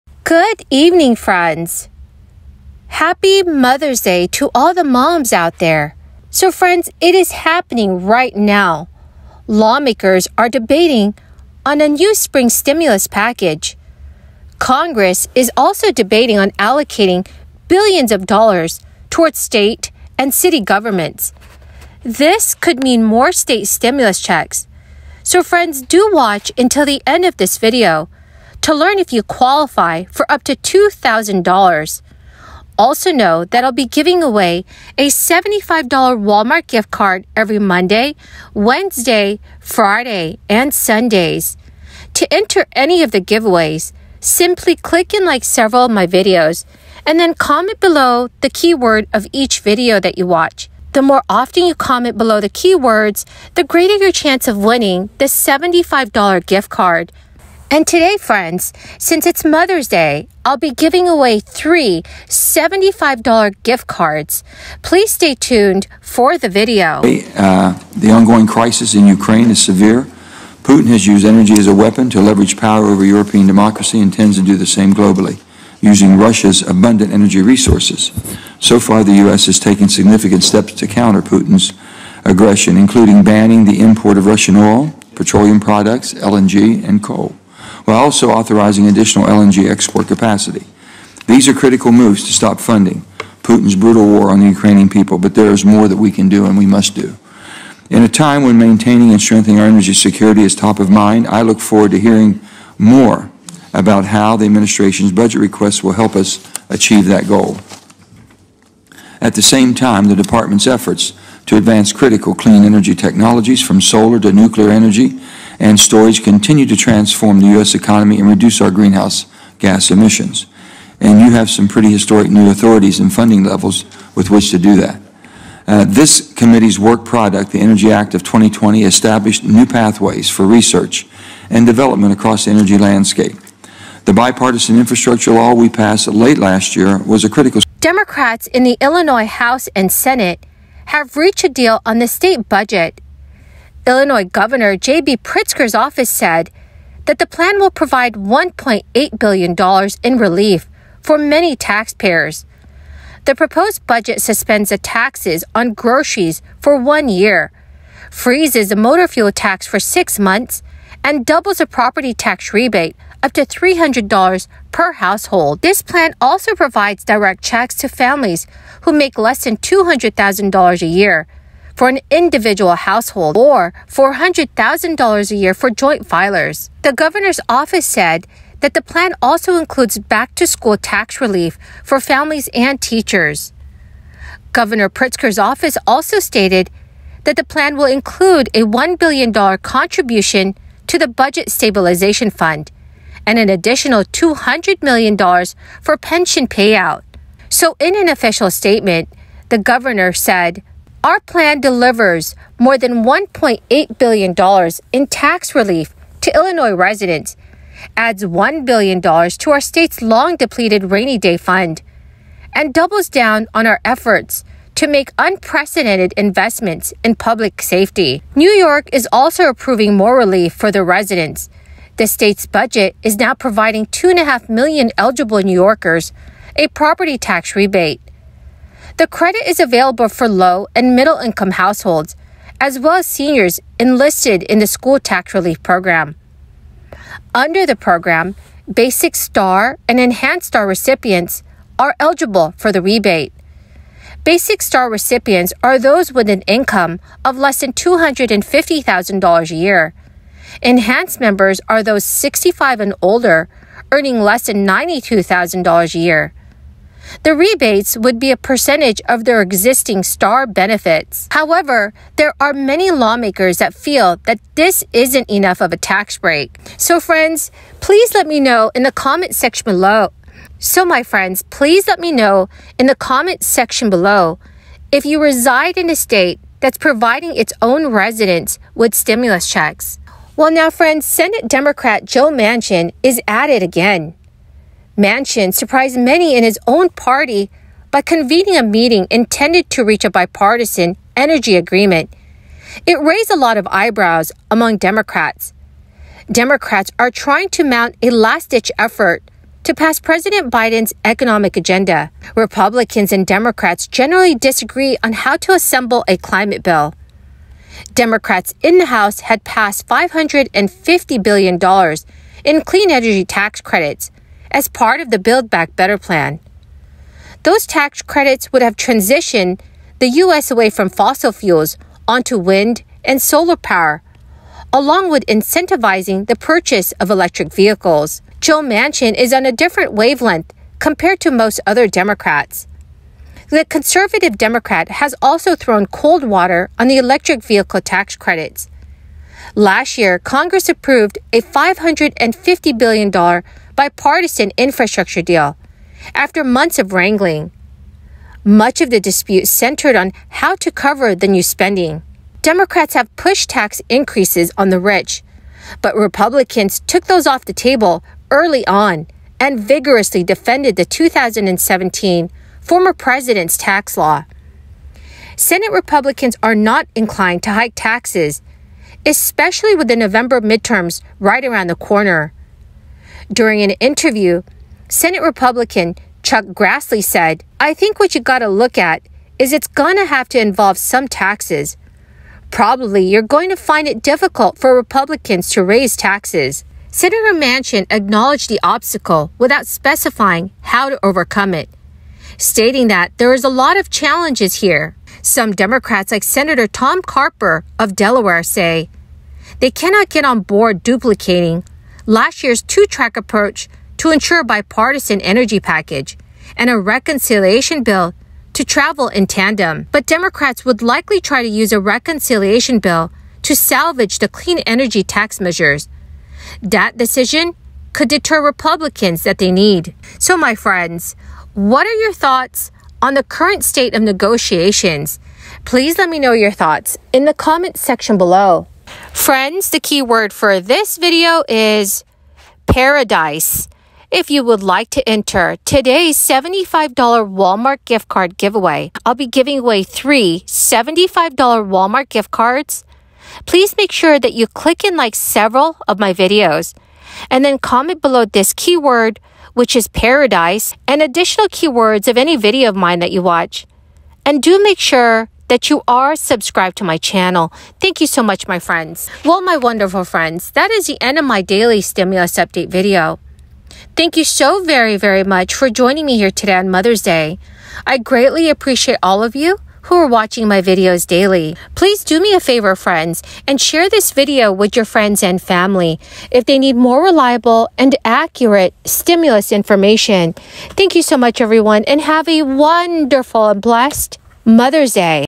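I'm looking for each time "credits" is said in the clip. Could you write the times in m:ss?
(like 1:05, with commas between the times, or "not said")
3:49, 5:13, 5:18, 5:38.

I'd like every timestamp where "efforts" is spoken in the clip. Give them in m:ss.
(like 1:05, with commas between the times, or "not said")
1:50, 3:33, 4:58.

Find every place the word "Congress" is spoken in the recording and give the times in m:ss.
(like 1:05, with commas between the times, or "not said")
0:14, 5:40.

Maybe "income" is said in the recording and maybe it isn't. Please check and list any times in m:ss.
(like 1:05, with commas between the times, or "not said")
3:51, 4:06.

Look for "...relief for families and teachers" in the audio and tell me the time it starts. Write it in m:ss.
3:01.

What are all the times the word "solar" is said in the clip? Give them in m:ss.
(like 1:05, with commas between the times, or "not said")
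1:53, 5:23.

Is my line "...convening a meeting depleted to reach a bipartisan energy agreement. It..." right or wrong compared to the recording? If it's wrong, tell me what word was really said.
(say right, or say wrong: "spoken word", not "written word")
wrong: "intended", not "depleted".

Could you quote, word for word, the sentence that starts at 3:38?
New York is also approving more relief for the residents.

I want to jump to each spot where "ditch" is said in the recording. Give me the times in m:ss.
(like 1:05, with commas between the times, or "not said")
4:58.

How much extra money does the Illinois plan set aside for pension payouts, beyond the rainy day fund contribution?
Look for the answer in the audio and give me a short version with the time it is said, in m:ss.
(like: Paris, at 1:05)
$200 million, at 3:14.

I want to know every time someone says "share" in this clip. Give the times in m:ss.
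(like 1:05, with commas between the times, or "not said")
7:53.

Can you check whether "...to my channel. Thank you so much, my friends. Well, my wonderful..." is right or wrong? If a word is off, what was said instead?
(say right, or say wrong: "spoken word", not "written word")
right.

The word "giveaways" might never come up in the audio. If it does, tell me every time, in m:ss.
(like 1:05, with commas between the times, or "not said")
0:43, 7:18.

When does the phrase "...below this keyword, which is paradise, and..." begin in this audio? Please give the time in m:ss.
7:28.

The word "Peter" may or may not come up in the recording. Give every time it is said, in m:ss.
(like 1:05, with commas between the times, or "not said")
not said.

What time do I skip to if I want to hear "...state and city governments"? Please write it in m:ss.
0:19.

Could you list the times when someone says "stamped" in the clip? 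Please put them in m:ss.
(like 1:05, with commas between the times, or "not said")
not said.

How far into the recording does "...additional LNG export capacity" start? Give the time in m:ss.
1:28.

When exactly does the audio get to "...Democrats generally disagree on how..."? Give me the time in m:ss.
5:03.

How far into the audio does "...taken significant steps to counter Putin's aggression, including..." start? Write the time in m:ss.
1:19.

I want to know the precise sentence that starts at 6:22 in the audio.
Probably you're going to find it difficult for Republicans to raise taxes.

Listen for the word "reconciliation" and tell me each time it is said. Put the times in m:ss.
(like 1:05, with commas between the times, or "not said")
6:46, 6:51.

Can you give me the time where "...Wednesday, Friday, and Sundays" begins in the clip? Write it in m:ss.
0:38.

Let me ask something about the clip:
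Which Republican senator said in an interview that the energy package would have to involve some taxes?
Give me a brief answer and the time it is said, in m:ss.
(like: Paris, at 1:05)
Chuck Grassley, at 6:16.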